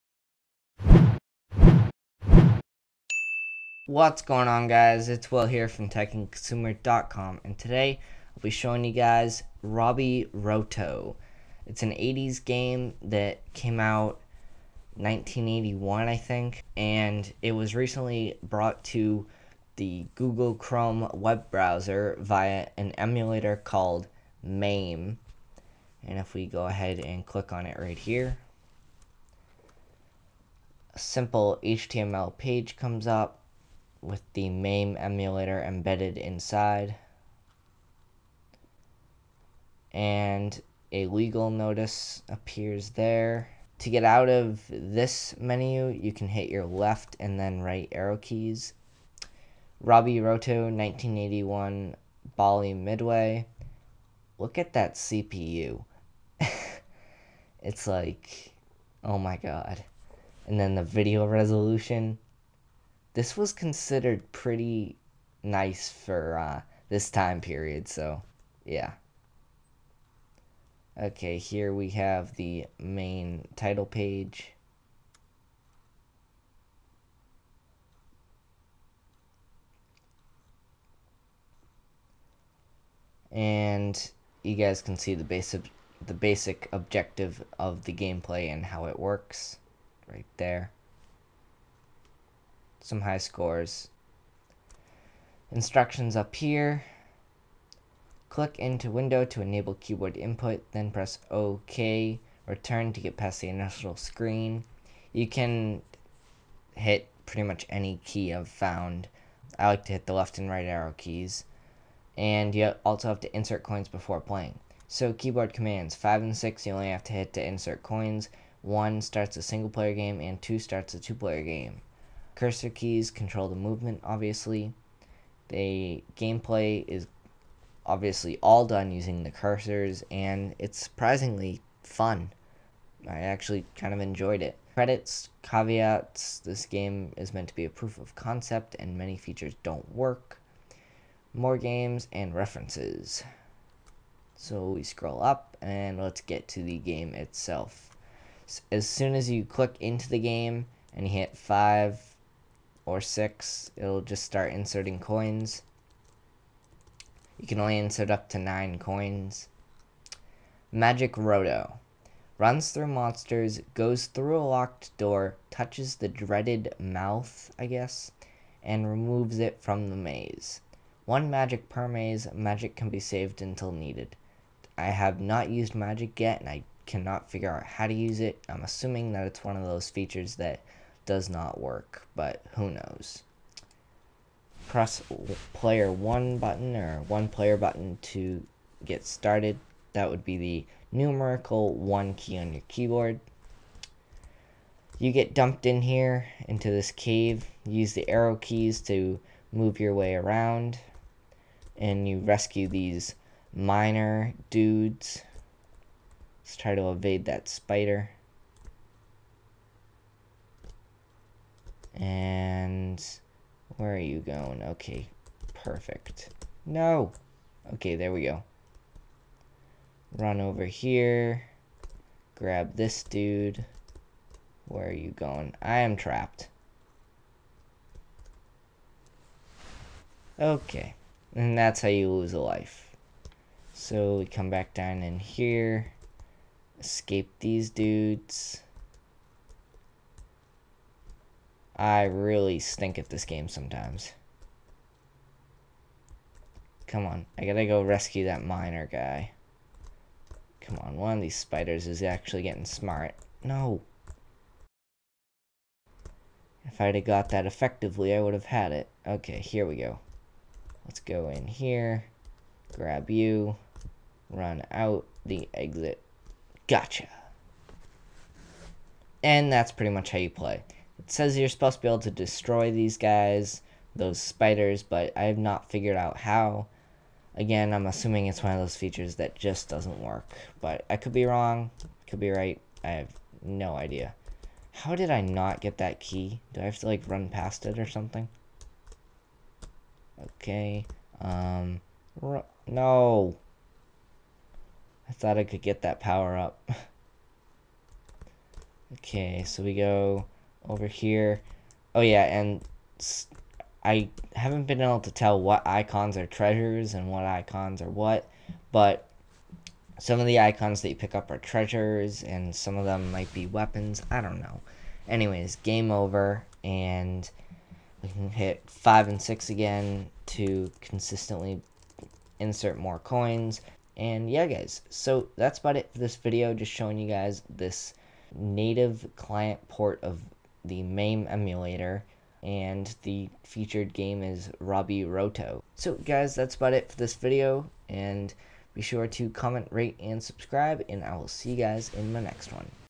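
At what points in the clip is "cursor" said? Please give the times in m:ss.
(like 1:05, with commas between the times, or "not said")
2:02, 2:09.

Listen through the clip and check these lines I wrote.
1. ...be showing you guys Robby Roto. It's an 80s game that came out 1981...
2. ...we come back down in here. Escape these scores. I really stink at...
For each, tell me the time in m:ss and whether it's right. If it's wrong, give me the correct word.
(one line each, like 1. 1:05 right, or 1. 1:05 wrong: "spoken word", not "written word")
1. 0:08 right
2. 3:54 wrong: "dudes", not "scores".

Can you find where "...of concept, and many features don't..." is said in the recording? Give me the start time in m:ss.
2:17.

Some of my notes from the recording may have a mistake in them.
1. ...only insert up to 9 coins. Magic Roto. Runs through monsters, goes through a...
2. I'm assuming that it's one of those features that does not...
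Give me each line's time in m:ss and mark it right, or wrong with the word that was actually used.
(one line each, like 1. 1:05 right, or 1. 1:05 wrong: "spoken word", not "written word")
1. 2:37 right
2. 2:58 right.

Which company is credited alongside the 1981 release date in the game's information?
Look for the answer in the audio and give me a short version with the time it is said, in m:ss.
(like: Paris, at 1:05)
Bally Midway, at 0:52.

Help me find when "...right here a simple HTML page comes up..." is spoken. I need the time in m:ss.
0:27.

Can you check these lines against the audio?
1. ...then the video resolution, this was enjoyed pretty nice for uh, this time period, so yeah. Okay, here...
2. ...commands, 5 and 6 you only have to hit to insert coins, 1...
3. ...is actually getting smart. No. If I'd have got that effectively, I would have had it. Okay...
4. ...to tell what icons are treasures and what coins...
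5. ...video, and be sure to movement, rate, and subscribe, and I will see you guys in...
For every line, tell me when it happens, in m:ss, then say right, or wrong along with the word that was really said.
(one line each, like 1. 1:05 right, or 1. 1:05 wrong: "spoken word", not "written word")
1. 1:00 wrong: "considered", not "enjoyed"
2. 1:55 right
3. 4:11 right
4. 5:05 wrong: "icons", not "coins"
5. 5:37 wrong: "comment", not "movement".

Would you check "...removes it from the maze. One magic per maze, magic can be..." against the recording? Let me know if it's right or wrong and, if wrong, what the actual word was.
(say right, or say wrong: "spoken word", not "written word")
right.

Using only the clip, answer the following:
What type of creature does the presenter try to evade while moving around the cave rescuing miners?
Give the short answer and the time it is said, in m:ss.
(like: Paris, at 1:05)
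Spider, at 3:27.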